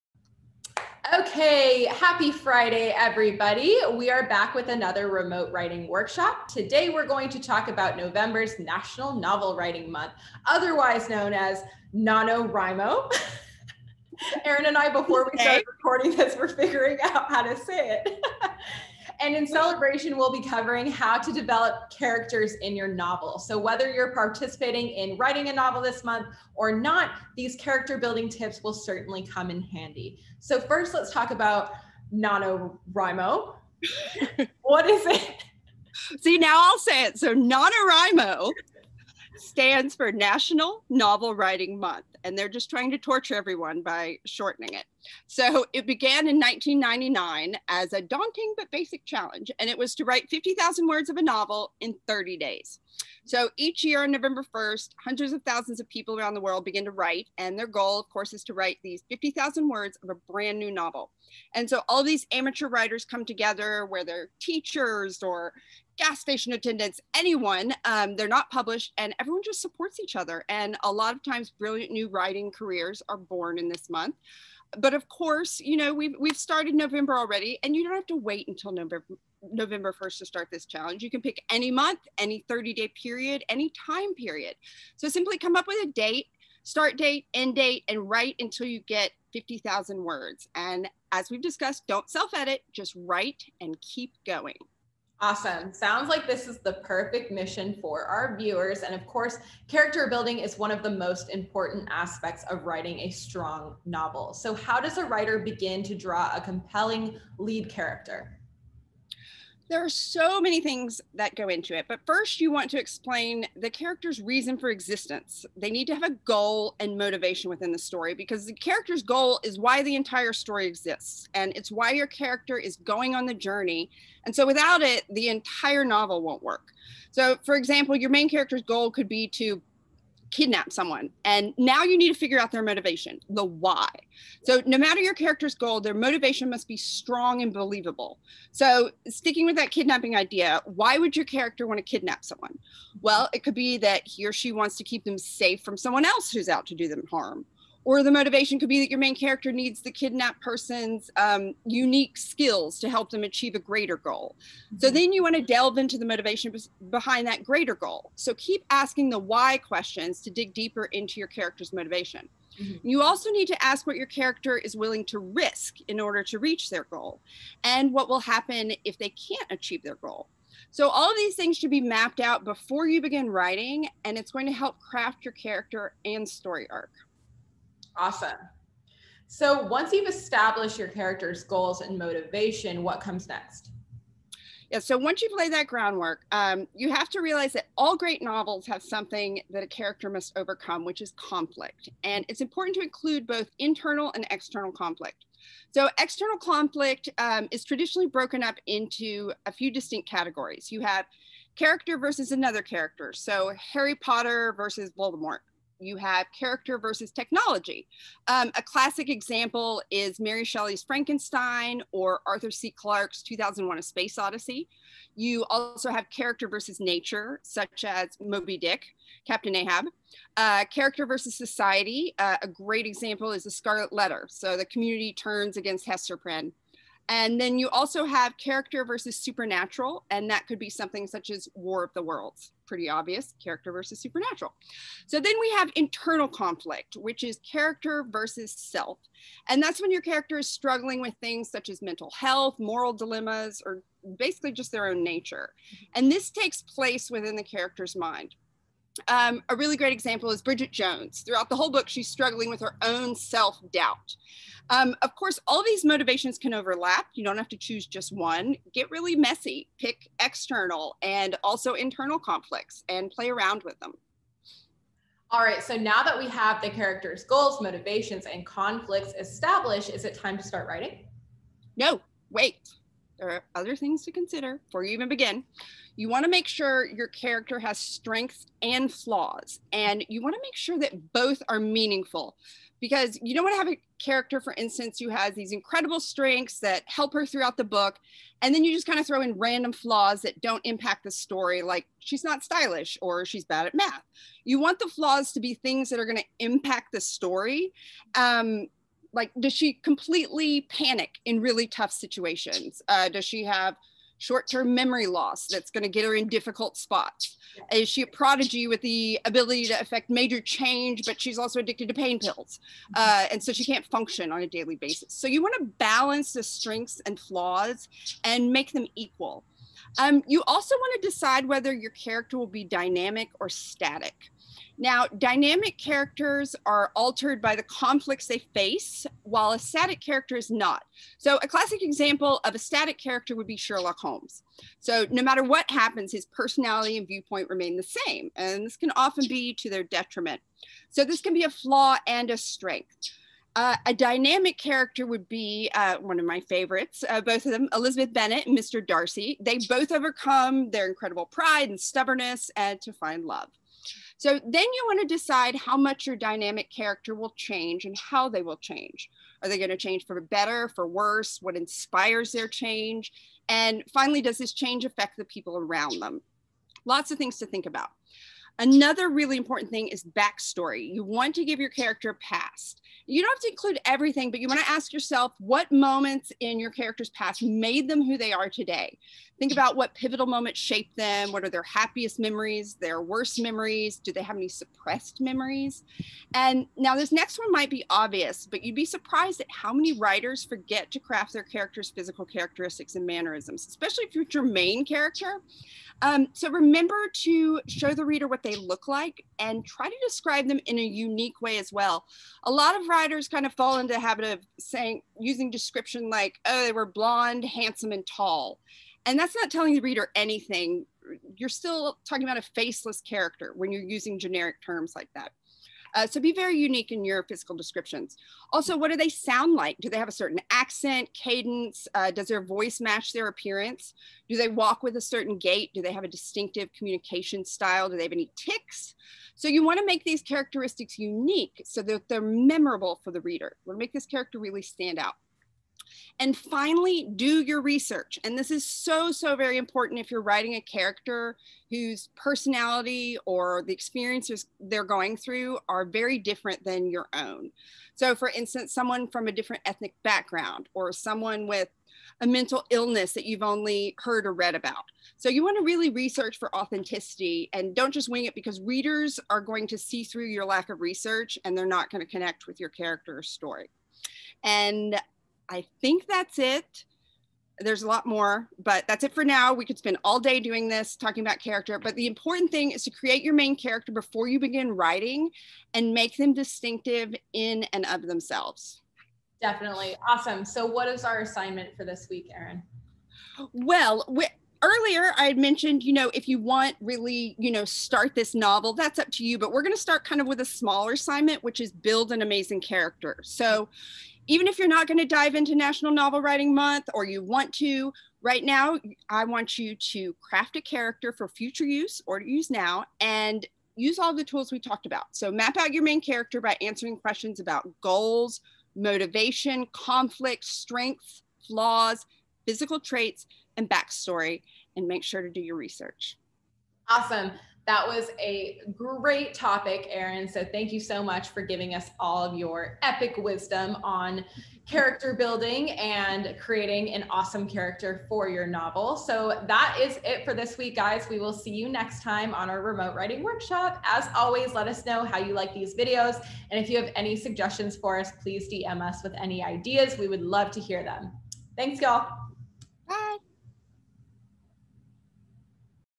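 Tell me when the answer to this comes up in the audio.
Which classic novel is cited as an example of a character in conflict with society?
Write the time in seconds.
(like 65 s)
223 s.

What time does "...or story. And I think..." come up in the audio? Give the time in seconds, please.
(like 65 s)
463 s.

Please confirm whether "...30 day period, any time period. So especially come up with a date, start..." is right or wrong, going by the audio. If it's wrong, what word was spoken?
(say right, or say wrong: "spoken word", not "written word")
wrong: "simply", not "especially".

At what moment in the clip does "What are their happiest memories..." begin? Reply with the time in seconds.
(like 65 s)
381 s.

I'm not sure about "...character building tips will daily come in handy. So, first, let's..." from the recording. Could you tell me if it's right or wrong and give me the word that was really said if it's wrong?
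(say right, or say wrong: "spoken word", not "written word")
wrong: "certainly", not "daily".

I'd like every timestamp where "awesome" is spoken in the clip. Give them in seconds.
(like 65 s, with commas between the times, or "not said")
95 s, 177 s, 480 s, 516 s, 527 s.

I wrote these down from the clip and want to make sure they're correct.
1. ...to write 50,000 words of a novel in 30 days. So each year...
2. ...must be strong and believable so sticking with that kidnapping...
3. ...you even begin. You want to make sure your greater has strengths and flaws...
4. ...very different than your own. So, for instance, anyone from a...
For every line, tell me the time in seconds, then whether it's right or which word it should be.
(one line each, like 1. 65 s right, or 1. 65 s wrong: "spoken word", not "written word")
1. 49 s right
2. 136 s right
3. 274 s wrong: "character", not "greater"
4. 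445 s wrong: "someone", not "anyone".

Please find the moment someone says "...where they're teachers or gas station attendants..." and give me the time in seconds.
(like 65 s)
63 s.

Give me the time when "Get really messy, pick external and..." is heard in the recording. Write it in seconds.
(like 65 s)
258 s.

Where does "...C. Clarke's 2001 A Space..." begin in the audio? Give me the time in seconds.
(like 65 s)
212 s.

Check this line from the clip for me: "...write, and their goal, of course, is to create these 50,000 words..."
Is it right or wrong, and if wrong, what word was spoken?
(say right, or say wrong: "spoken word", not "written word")
wrong: "write", not "create".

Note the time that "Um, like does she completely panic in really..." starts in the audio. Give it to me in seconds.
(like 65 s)
298 s.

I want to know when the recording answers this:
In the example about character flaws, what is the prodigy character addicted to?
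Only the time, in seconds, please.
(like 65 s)
311 s.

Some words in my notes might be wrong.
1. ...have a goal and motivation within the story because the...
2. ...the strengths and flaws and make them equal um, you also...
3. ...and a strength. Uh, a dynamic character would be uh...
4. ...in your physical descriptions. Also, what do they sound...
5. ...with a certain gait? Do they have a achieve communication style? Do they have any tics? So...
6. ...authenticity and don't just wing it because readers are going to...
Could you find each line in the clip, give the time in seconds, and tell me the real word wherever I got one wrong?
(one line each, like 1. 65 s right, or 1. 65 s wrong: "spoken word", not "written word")
1. 115 s right
2. 316 s right
3. 342 s right
4. 416 s right
5. 424 s wrong: "distinctive", not "achieve"
6. 456 s right.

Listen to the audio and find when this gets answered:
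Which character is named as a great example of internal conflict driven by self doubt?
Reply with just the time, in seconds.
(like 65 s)
250 s.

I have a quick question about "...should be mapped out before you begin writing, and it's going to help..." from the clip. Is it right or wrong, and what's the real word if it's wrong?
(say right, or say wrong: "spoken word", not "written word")
right.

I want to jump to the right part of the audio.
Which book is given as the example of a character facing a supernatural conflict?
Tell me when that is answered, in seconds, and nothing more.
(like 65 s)
231 s.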